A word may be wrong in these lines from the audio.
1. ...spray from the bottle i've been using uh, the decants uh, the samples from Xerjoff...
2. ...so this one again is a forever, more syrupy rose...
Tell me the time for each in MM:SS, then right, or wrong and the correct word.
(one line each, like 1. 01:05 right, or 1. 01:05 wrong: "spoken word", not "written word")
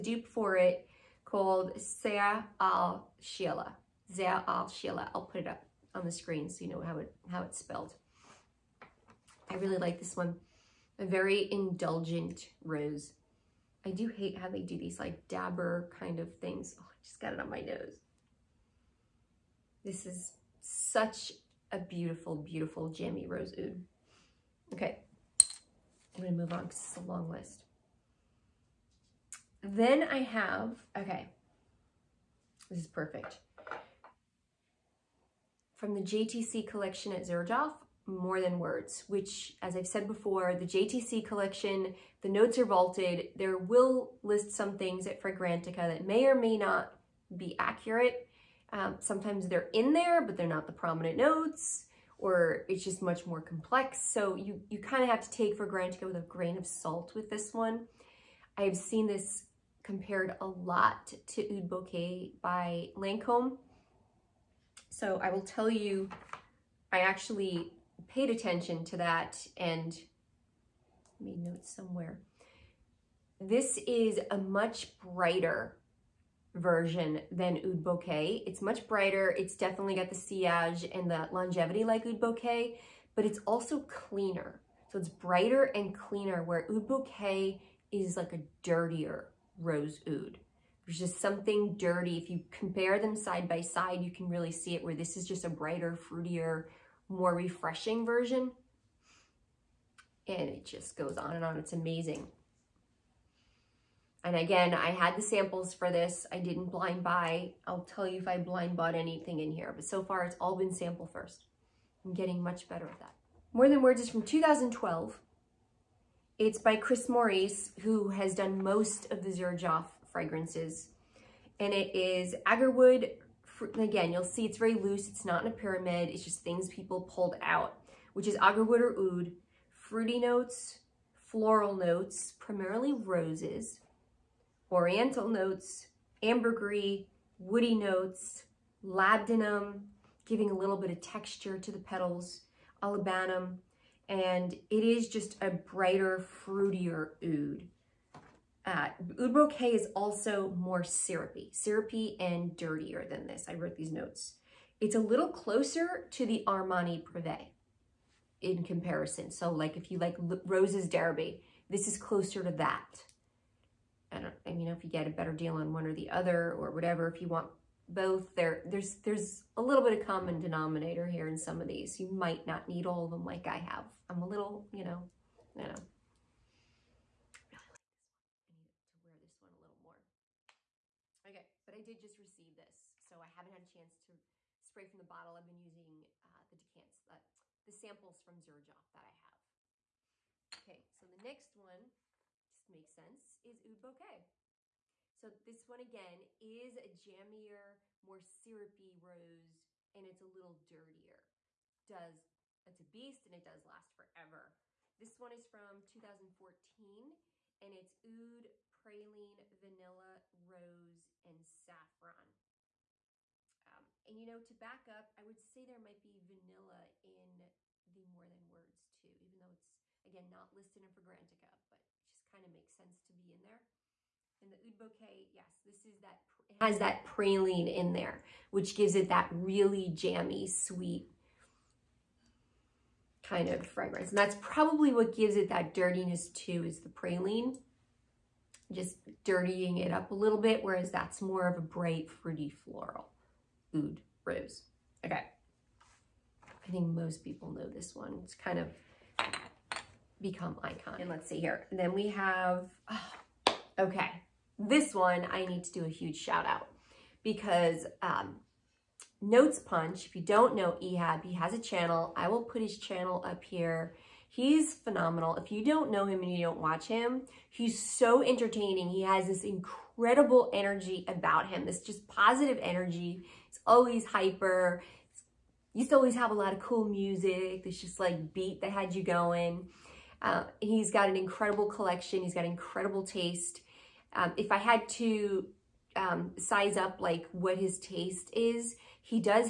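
1. 03:04 right
2. 03:15 wrong: "jammier", not "forever".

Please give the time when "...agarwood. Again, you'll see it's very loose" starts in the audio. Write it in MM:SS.
02:02.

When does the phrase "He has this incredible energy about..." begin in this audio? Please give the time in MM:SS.
04:28.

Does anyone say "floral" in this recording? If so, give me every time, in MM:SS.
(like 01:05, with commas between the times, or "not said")
02:11, 04:02.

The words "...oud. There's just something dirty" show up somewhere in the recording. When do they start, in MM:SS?
01:30.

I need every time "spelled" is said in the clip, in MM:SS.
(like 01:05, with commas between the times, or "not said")
00:07.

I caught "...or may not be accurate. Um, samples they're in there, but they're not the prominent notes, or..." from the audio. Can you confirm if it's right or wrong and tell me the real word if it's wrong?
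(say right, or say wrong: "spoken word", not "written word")
wrong: "sometimes", not "samples".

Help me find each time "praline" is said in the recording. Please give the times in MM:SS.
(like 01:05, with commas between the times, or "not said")
03:28, 03:47, 03:56.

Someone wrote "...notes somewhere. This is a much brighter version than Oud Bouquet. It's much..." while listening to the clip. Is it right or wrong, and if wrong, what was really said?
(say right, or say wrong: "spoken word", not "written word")
right.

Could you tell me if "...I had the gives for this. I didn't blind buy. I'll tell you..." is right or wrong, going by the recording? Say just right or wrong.
wrong.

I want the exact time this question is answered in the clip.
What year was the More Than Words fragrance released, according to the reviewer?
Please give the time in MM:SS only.
01:54.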